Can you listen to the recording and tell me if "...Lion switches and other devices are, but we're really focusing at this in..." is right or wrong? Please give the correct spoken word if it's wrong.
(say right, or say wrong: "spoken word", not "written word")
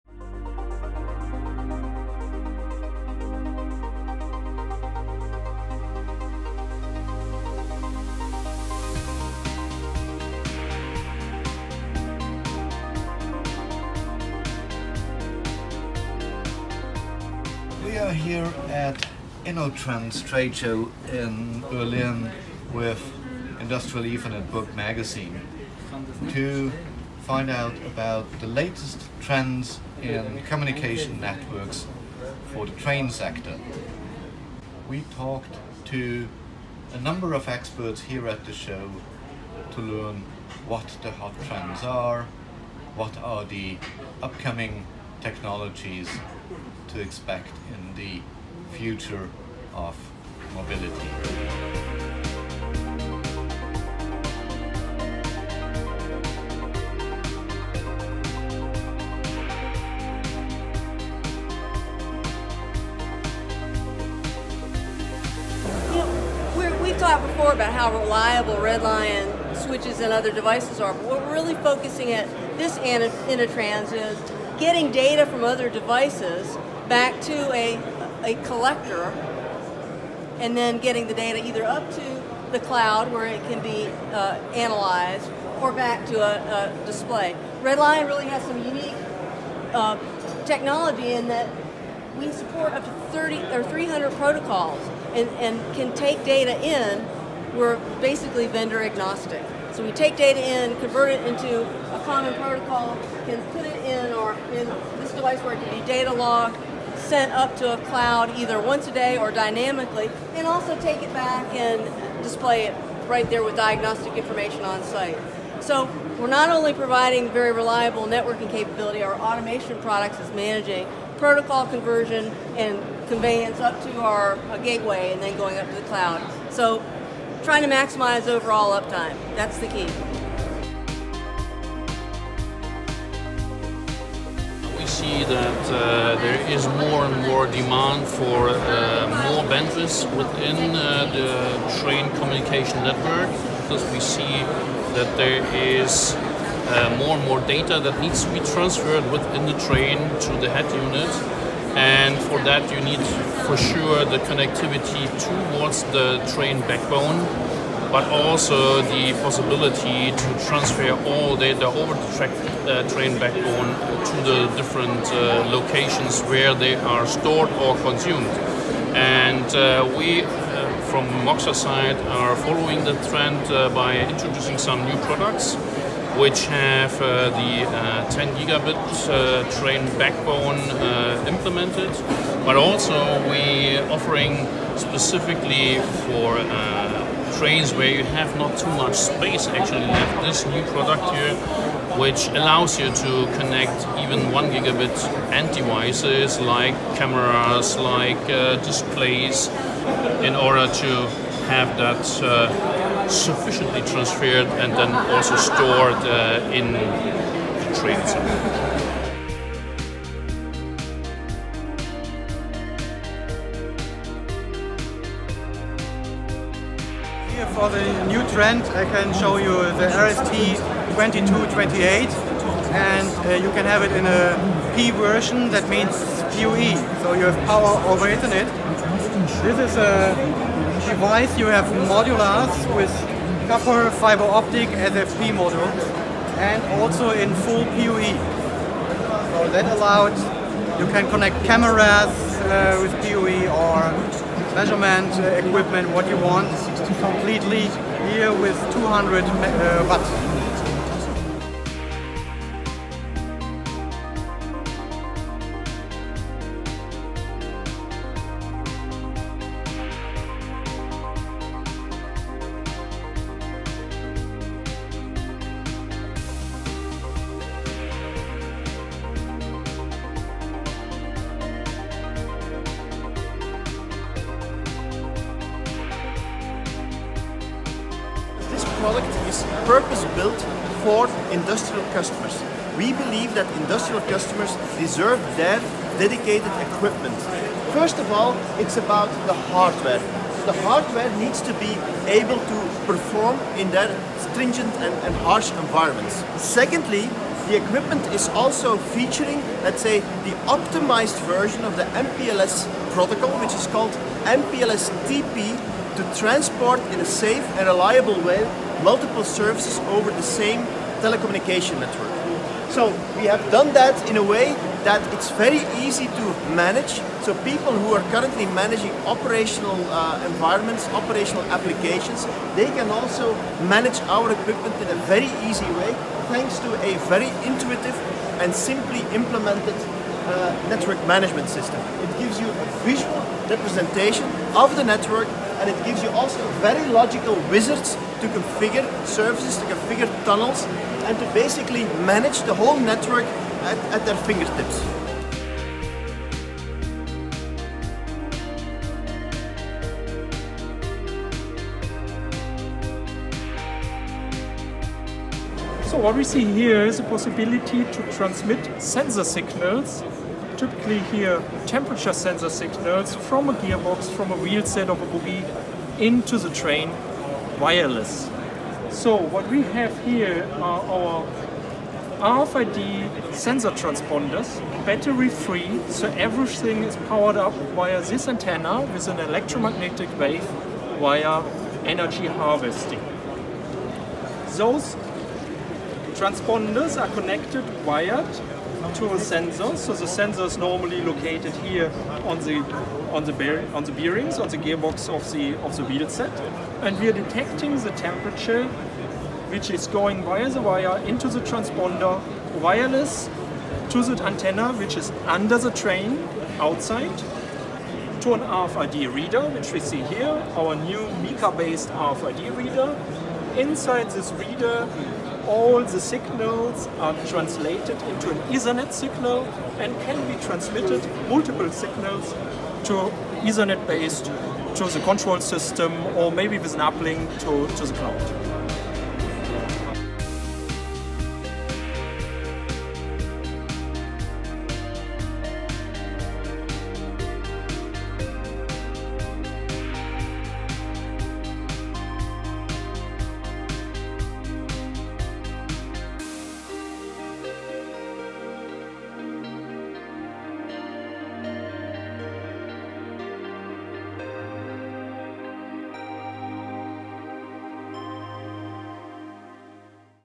right.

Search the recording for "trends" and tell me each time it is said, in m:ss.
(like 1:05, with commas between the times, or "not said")
0:29, 0:41, 2:53, 3:38.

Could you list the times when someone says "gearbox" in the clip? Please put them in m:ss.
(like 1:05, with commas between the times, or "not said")
6:03, 6:34.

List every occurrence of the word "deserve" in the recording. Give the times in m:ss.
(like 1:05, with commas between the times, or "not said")
4:44.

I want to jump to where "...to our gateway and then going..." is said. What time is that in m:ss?
2:03.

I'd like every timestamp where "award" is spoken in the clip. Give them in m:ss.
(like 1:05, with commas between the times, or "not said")
not said.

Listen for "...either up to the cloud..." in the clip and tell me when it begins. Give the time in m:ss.
1:21.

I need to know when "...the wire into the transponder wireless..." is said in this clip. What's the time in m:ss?
6:40.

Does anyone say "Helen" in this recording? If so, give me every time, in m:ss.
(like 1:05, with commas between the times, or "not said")
not said.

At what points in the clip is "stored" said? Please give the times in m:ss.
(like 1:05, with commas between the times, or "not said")
2:47, 3:25.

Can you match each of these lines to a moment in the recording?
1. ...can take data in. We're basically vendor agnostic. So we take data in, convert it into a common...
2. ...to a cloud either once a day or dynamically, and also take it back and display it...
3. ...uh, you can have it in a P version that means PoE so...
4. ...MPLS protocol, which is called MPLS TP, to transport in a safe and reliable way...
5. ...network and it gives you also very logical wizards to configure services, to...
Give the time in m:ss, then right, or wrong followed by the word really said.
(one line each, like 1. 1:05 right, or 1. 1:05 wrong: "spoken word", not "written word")
1. 1:35 right
2. 1:47 right
3. 3:43 right
4. 5:02 right
5. 5:34 right.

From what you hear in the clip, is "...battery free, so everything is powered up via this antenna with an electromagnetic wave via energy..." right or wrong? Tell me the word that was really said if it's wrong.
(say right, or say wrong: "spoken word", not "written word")
right.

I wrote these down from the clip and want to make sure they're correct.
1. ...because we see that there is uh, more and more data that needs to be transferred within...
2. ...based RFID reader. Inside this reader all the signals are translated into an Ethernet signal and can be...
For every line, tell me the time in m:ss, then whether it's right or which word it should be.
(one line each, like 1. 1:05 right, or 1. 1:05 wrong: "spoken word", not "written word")
1. 2:23 right
2. 6:51 right.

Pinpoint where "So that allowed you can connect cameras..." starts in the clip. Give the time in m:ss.
3:59.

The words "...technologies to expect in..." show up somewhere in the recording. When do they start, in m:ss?
0:45.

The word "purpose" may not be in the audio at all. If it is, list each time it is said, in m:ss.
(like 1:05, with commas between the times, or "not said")
4:39.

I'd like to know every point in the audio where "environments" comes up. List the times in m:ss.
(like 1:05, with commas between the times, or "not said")
4:55, 5:20.